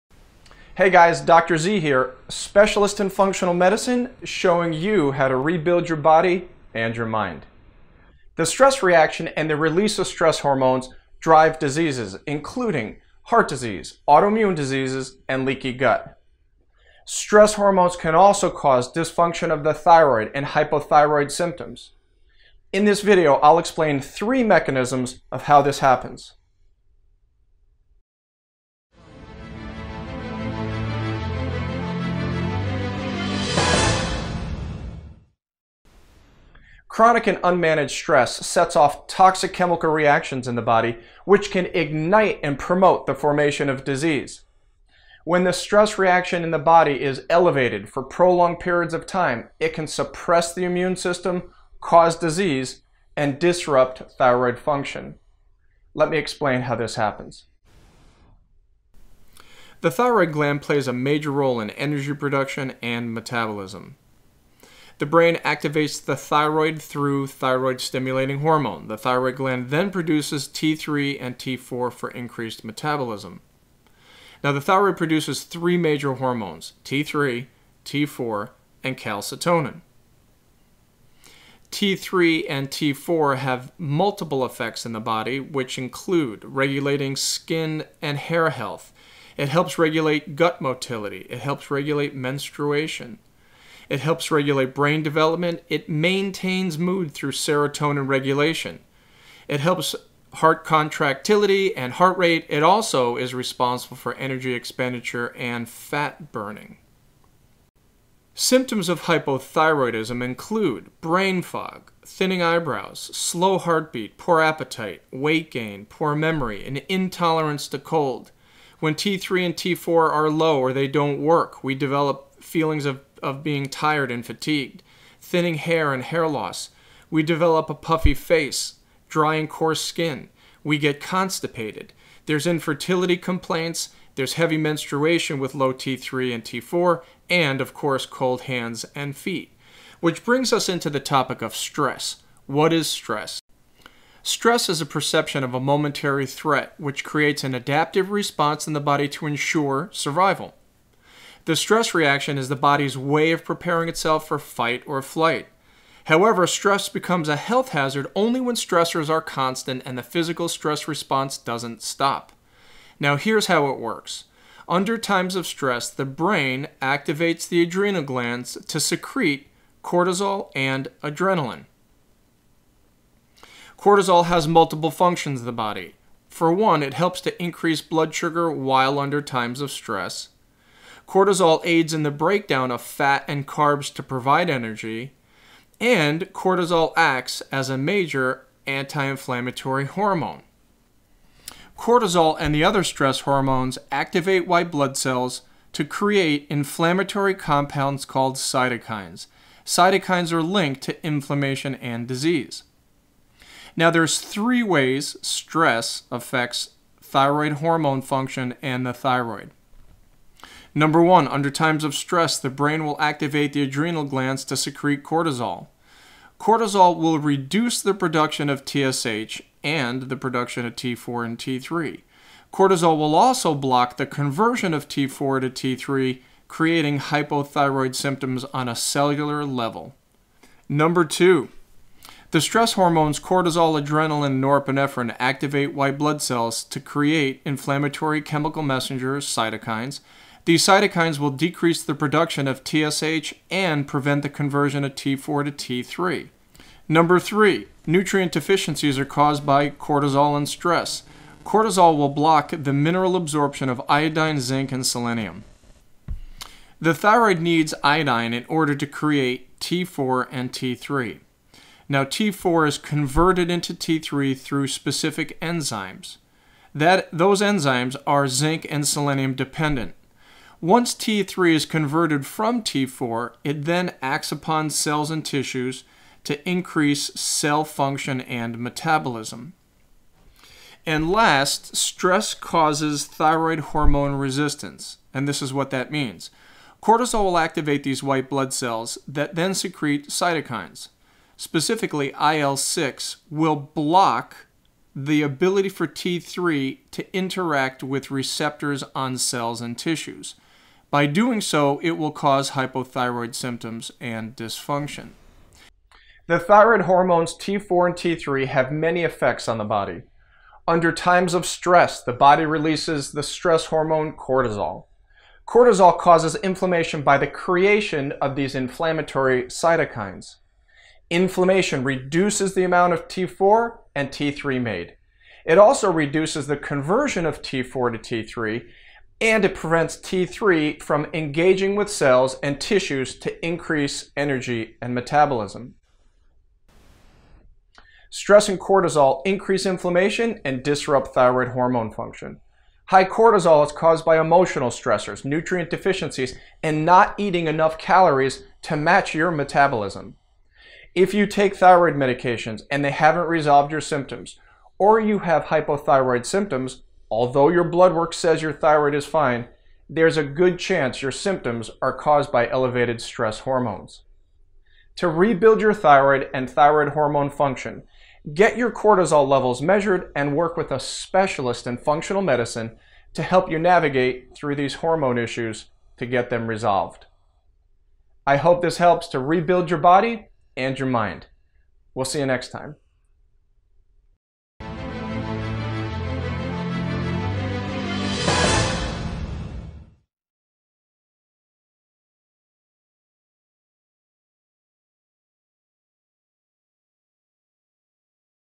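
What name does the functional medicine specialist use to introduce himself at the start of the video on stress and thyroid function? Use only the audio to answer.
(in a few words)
Dr. Z.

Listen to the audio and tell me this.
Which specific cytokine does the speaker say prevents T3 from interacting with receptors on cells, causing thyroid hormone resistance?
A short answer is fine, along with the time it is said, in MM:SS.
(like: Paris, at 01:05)
IL-6, at 04:52.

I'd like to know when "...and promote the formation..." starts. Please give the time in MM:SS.
00:42.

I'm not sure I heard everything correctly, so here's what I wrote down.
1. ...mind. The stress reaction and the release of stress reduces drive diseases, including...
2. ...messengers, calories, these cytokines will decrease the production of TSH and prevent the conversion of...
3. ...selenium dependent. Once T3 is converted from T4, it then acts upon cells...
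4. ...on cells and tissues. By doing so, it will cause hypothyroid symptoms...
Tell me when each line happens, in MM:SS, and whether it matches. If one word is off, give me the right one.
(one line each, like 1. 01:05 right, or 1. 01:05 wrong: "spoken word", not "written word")
1. 00:07 wrong: "hormones", not "reduces"
2. 03:58 wrong: "cytokines", not "calories"
3. 04:28 right
4. 04:58 right.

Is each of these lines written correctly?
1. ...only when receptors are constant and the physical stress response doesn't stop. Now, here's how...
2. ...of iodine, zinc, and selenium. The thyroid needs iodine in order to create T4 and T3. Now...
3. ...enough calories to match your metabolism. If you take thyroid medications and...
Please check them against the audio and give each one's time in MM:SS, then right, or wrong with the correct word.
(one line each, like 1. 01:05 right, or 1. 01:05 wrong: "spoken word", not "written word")
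1. 02:38 wrong: "stressors", not "receptors"
2. 04:13 right
3. 05:47 right.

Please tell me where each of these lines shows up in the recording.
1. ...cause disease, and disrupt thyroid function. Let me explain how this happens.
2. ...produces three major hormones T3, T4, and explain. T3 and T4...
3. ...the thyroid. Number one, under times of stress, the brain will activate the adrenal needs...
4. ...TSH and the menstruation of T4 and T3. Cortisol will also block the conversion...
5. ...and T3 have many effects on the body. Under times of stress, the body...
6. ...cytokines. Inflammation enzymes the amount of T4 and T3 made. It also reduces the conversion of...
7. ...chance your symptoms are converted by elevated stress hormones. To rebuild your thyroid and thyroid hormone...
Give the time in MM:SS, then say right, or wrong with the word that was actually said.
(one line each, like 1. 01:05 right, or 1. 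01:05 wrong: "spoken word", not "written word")
1. 00:51 right
2. 01:14 wrong: "calcitonin", not "explain"
3. 03:28 wrong: "glands", not "needs"
4. 03:38 wrong: "production", not "menstruation"
5. 05:07 right
6. 05:19 wrong: "reduces", not "enzymes"
7. 06:00 wrong: "caused", not "converted".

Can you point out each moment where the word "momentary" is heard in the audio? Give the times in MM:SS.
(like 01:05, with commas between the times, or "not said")
02:25.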